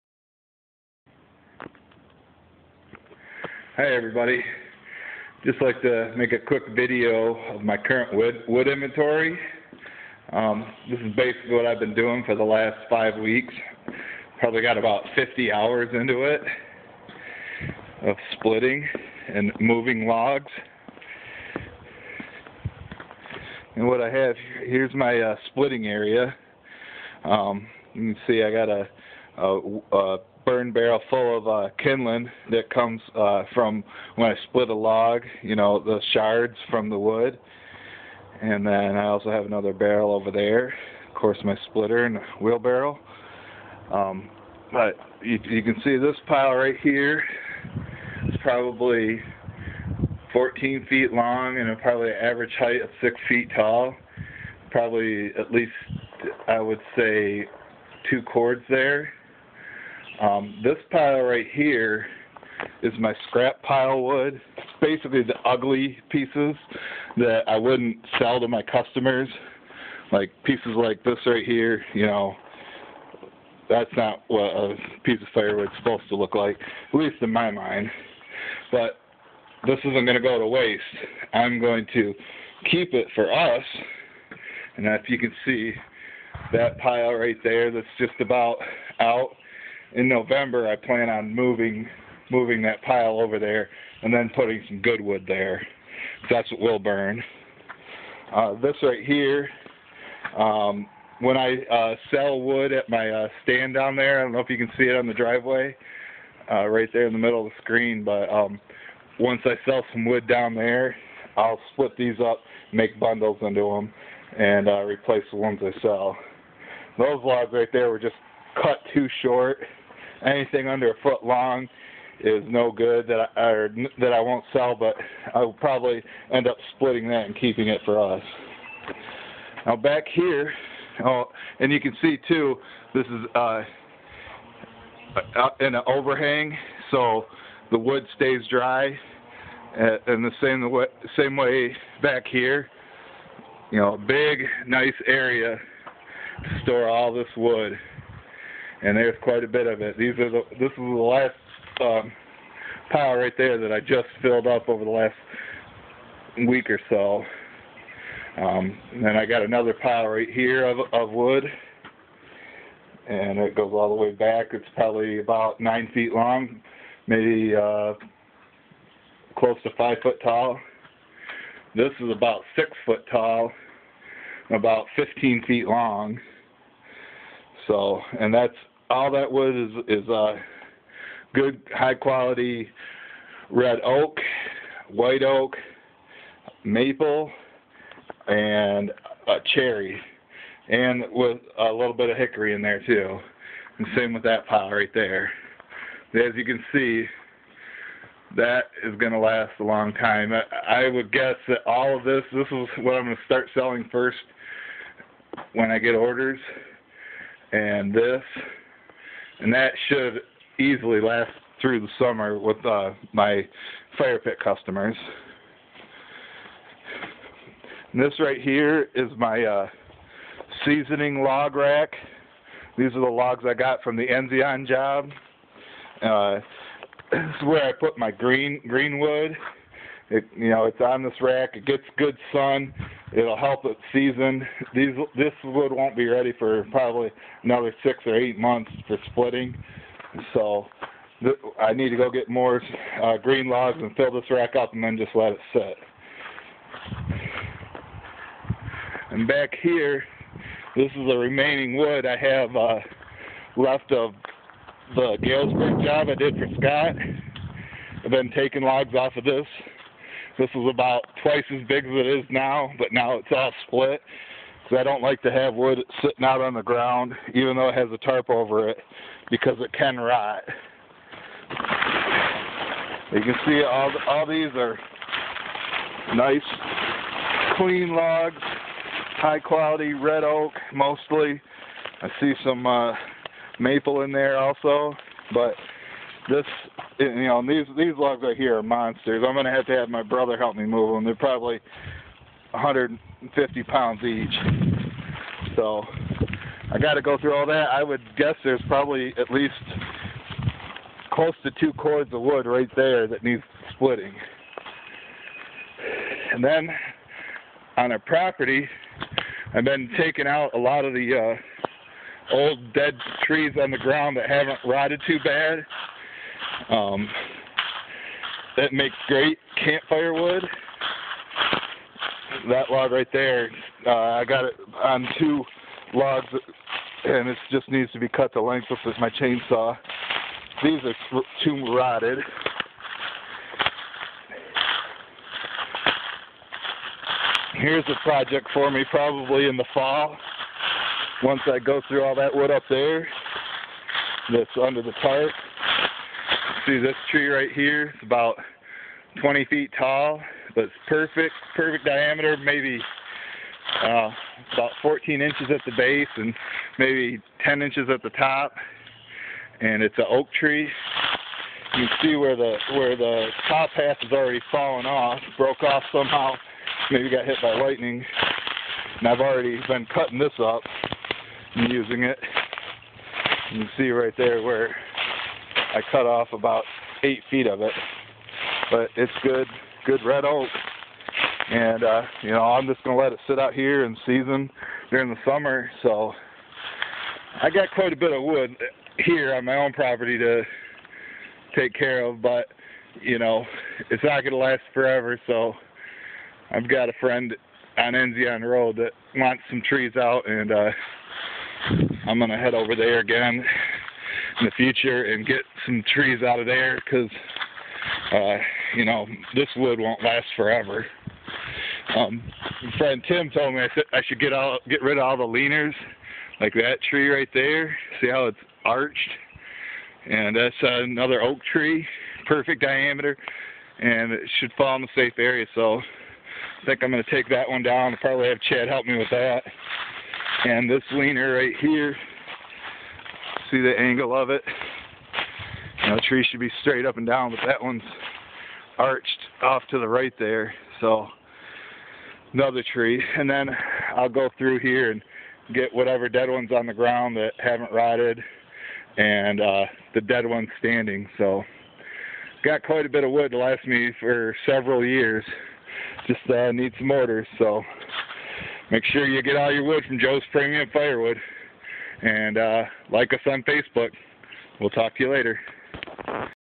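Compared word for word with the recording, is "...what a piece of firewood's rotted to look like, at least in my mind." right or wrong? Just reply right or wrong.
wrong.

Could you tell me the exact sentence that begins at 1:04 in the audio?
It's basically the ugly pieces that I wouldn't sell to my customers.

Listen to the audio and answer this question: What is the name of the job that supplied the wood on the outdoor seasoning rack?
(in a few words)
Enzion.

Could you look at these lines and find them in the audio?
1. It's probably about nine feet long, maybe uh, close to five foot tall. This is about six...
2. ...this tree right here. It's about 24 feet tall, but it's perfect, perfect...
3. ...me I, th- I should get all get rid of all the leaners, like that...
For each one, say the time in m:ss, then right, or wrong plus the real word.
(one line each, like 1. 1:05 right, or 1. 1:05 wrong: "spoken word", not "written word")
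1. 2:44 right
2. 5:46 wrong: "20", not "24"
3. 6:53 right.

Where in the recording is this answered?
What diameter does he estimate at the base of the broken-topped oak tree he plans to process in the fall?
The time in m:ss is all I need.
5:54.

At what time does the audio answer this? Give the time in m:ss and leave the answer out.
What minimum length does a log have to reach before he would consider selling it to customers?
2:00.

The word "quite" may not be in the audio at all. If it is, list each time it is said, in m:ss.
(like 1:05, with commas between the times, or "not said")
2:29, 6:27, 7:32.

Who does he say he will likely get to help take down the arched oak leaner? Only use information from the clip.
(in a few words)
Chad.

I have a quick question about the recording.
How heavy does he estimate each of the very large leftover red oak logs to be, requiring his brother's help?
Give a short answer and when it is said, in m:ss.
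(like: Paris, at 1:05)
150 pounds, at 4:52.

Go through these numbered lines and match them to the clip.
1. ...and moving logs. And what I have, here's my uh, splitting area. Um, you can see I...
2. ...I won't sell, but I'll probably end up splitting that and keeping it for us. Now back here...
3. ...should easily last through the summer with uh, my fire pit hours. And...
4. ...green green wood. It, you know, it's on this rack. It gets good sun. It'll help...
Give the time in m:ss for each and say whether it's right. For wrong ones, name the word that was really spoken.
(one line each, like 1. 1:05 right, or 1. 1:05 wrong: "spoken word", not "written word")
1. 0:19 right
2. 2:04 right
3. 3:29 wrong: "customers", not "hours"
4. 3:48 right.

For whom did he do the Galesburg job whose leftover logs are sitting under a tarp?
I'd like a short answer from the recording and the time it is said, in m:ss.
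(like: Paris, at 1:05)
Scott, at 4:16.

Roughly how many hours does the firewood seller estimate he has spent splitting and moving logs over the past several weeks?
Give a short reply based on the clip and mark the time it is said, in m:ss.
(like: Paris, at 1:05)
50, at 0:15.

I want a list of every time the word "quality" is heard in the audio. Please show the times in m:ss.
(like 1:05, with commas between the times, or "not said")
3:01, 4:39.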